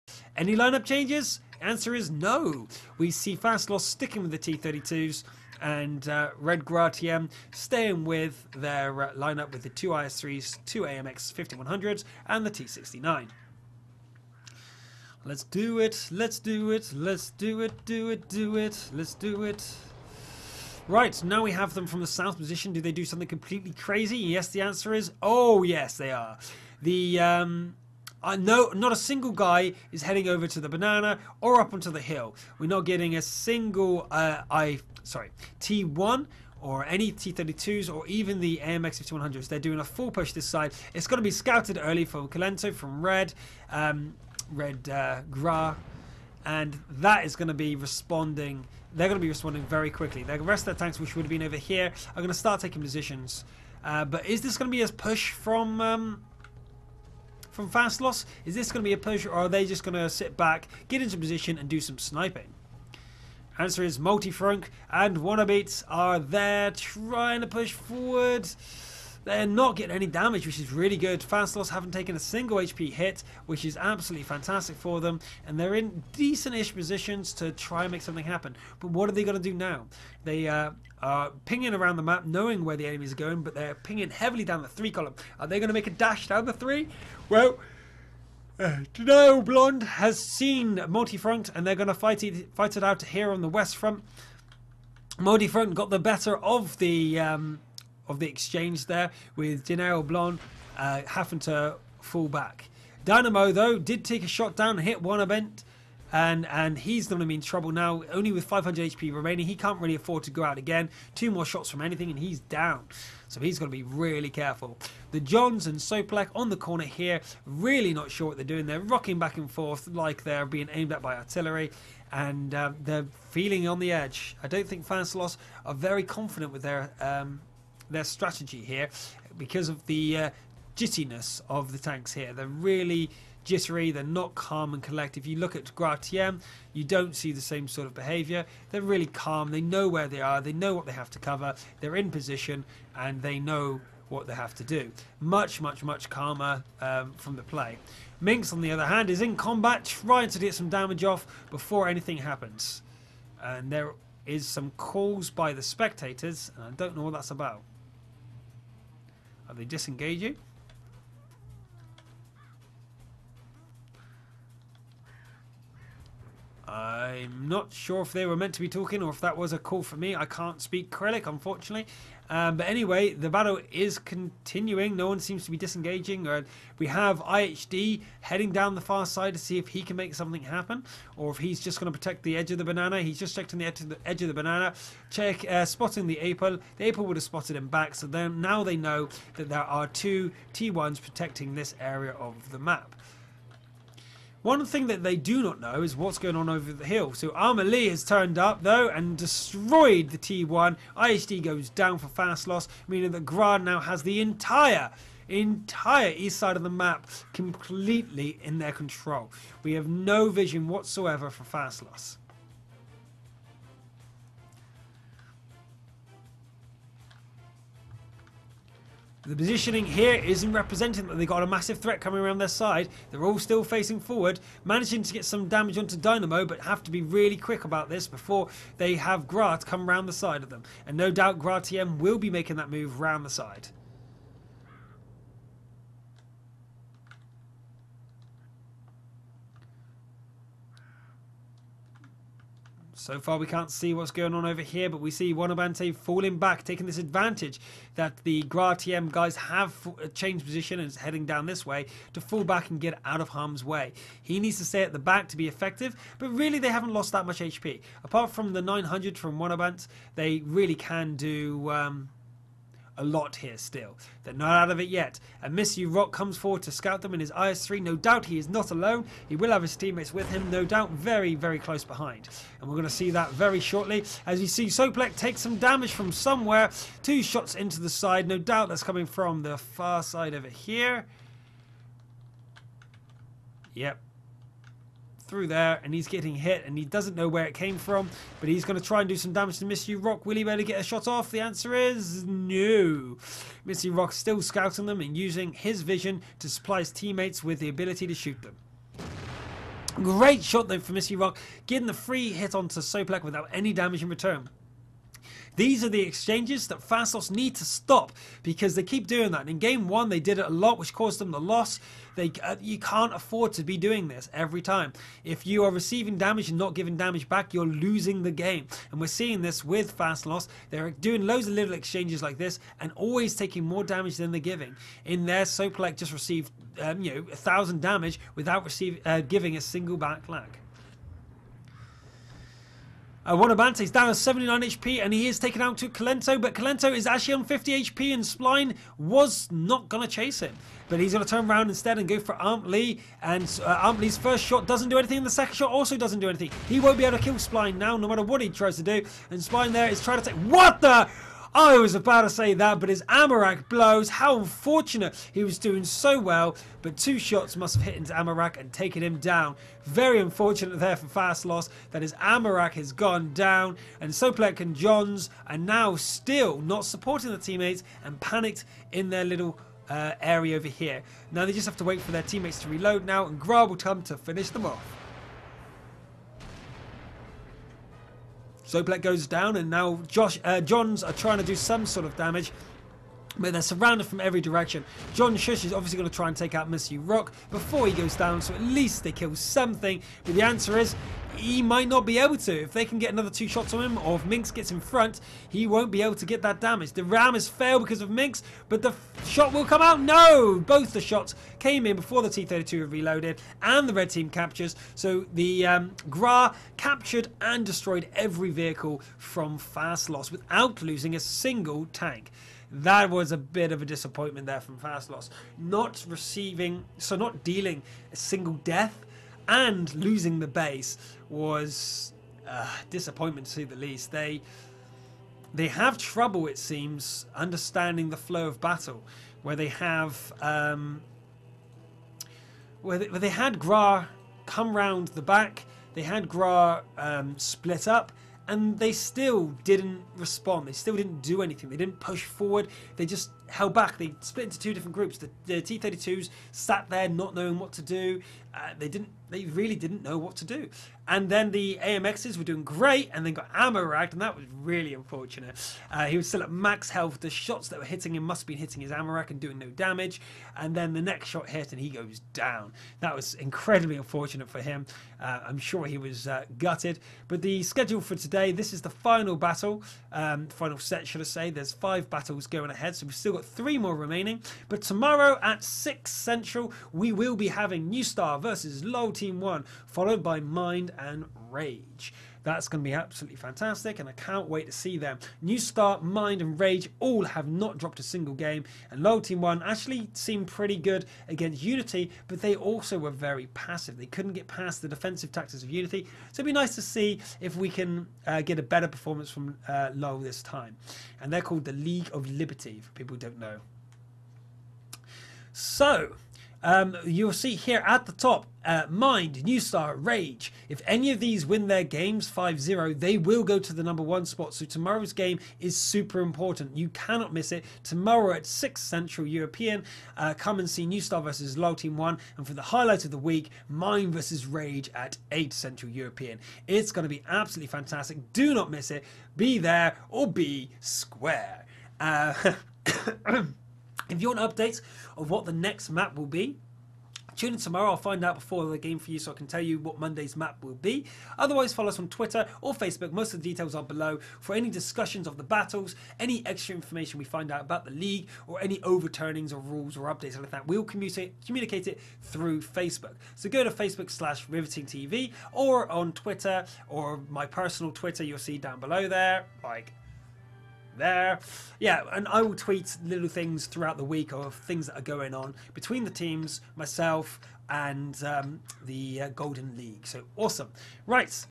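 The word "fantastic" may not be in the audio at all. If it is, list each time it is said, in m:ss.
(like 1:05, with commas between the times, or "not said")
1:14, 8:03, 8:47.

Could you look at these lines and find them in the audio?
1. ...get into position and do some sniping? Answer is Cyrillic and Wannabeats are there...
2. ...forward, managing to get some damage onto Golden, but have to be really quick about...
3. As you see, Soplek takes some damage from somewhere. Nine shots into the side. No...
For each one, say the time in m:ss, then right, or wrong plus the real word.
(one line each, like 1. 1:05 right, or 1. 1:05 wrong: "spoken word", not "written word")
1. 1:00 wrong: "Multifrunk", not "Cyrillic"
2. 3:43 wrong: "Dynamo", not "Golden"
3. 4:34 wrong: "Two", not "Nine".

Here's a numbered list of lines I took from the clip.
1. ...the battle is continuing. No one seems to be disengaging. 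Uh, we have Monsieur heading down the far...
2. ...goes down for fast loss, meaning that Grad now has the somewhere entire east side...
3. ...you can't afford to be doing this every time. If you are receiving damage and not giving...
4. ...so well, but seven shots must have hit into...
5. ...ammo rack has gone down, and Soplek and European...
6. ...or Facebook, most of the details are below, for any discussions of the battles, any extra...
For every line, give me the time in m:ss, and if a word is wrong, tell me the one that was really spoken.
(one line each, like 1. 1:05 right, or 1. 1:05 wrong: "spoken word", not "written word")
1. 2:53 wrong: "IHD", not "Monsieur"
2. 3:21 wrong: "entire", not "somewhere"
3. 5:12 right
4. 5:55 wrong: "two", not "seven"
5. 6:02 wrong: "Johns", not "European"
6. 9:02 right.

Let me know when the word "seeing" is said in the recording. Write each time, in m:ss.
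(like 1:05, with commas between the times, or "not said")
5:19.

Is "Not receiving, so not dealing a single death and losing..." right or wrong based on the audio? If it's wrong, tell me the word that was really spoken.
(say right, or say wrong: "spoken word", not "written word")
right.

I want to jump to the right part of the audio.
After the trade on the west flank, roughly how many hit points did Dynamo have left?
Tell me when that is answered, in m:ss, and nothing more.
1:48.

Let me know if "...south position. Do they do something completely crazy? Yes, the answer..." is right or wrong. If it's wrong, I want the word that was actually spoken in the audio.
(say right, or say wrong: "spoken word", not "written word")
right.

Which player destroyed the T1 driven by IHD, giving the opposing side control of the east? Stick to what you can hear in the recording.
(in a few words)
Armour Lee.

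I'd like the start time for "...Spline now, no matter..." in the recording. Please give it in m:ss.
5:47.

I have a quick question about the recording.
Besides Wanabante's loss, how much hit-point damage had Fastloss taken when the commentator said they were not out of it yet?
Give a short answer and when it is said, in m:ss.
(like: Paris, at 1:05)
900, at 4:18.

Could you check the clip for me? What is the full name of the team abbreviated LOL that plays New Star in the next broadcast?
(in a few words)
League of Liberty.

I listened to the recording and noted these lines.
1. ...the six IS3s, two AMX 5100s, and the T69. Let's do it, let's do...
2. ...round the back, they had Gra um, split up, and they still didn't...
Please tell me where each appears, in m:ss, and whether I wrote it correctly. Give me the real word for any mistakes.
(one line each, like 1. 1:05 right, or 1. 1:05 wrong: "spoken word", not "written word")
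1. 0:09 wrong: "two", not "six"
2. 7:14 right.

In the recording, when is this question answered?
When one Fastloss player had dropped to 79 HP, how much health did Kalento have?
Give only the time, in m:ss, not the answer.
5:37.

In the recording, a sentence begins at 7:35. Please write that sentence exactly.
Uh, he was still at max health.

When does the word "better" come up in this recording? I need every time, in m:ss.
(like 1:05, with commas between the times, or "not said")
1:35, 8:18.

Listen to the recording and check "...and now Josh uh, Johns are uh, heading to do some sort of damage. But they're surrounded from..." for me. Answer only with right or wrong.
wrong.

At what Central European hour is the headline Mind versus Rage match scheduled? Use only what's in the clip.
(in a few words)
8.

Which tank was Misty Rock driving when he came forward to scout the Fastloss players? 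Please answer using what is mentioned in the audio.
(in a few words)
IS-3.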